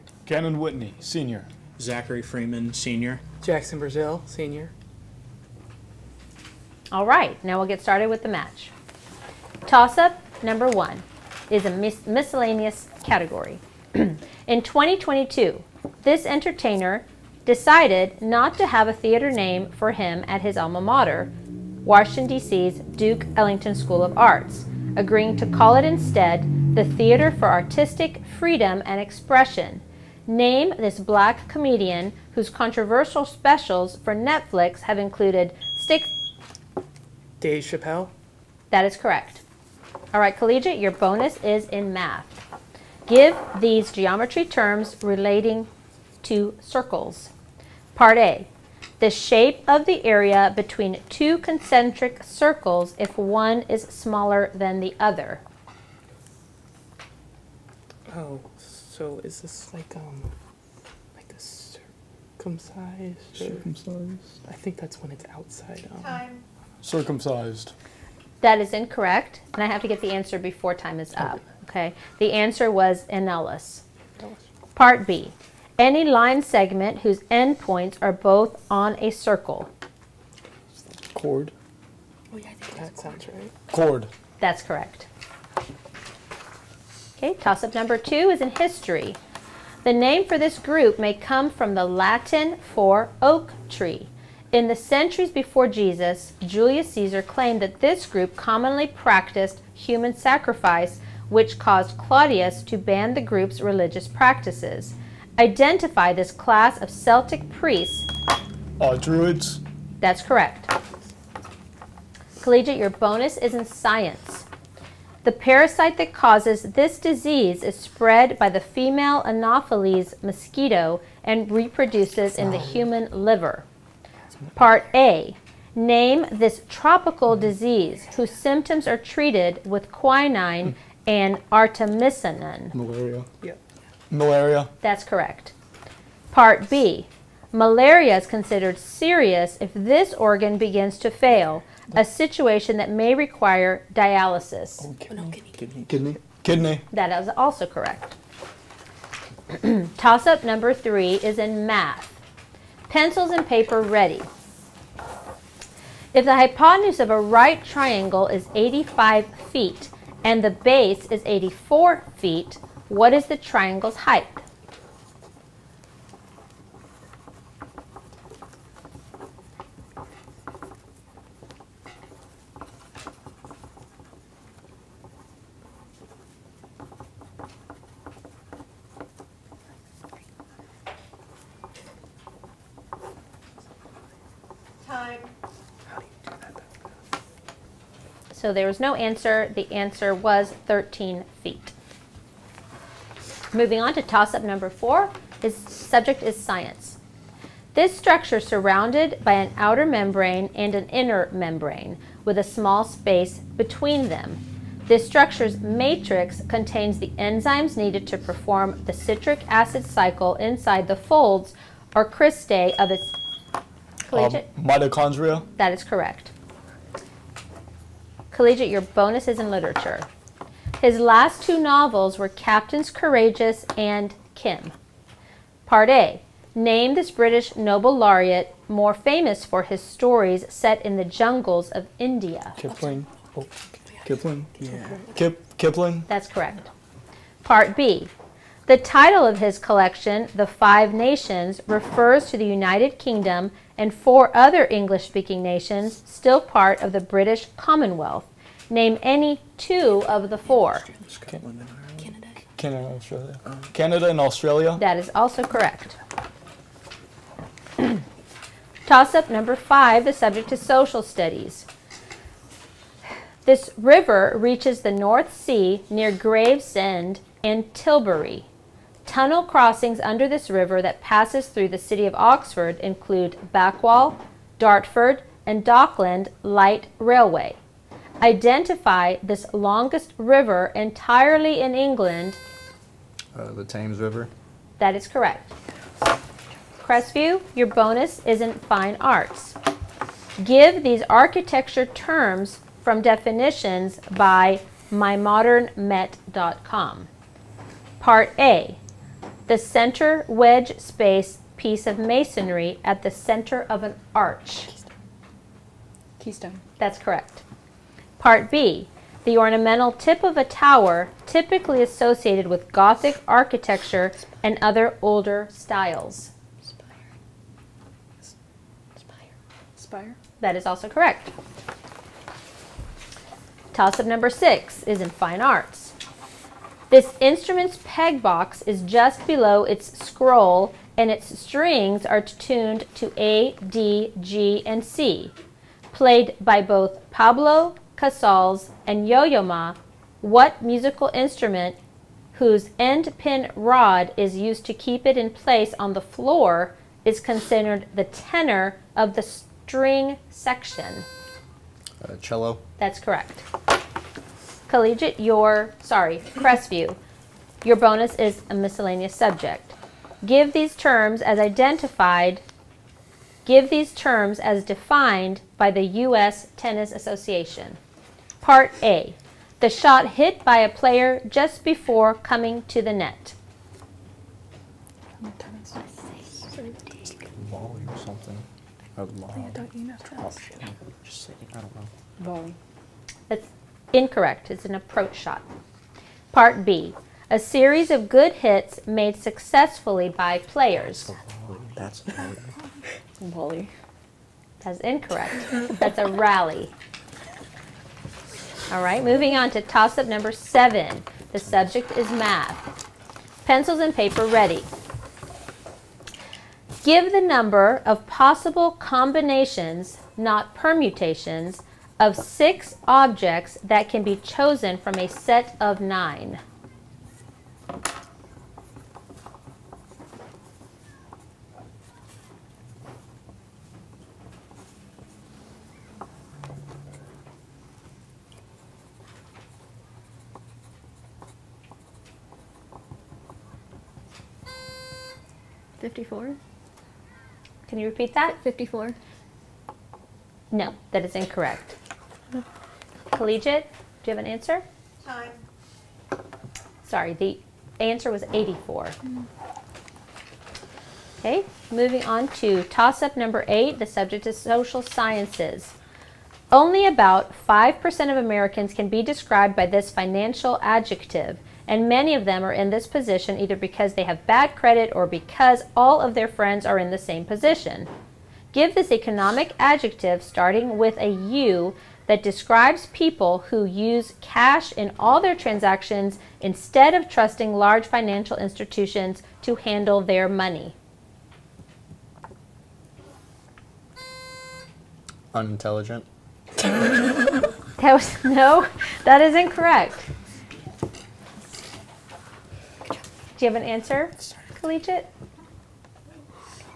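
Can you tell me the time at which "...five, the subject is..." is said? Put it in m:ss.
4:19.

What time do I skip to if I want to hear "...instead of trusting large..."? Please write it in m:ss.
7:56.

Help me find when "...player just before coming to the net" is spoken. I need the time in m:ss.
6:10.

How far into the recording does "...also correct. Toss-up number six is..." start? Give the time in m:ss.
5:20.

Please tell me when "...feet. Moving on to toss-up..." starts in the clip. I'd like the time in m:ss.
3:11.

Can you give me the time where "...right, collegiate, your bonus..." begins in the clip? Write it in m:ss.
0:40.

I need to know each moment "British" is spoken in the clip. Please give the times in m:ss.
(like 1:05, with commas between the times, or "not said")
3:47, 4:07.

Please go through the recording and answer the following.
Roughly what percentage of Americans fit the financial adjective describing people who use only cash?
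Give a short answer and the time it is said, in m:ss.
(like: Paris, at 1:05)
5%, at 7:37.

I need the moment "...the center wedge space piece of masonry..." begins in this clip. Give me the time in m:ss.
4:59.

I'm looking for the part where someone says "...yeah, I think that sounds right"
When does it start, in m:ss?
1:22.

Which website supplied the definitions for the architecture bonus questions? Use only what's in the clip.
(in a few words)
mymodernmet.com.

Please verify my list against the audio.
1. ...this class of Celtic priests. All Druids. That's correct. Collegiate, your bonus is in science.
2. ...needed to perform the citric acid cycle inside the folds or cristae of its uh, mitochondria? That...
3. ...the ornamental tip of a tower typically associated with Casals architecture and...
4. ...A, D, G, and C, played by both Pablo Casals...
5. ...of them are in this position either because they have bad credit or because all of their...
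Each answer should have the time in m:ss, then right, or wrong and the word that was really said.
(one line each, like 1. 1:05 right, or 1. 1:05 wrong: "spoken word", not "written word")
1. 1:46 right
2. 3:27 right
3. 5:09 wrong: "Gothic", not "Casals"
4. 5:33 right
5. 7:42 right.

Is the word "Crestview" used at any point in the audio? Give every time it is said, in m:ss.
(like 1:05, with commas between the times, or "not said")
4:46, 5:56.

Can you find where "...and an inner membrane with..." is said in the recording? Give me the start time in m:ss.
3:20.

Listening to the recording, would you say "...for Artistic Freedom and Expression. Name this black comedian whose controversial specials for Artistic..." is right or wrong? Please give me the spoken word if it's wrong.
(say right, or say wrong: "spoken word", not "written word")
wrong: "Netflix", not "Artistic".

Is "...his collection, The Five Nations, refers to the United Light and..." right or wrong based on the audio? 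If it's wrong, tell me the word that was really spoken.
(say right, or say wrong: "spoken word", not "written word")
wrong: "Kingdom", not "Light".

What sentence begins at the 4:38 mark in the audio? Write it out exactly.
Identify this longest river entirely in England.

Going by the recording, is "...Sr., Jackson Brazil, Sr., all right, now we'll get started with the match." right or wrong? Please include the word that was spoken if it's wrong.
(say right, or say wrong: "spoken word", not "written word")
right.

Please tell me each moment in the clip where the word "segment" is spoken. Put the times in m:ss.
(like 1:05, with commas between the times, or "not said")
1:16.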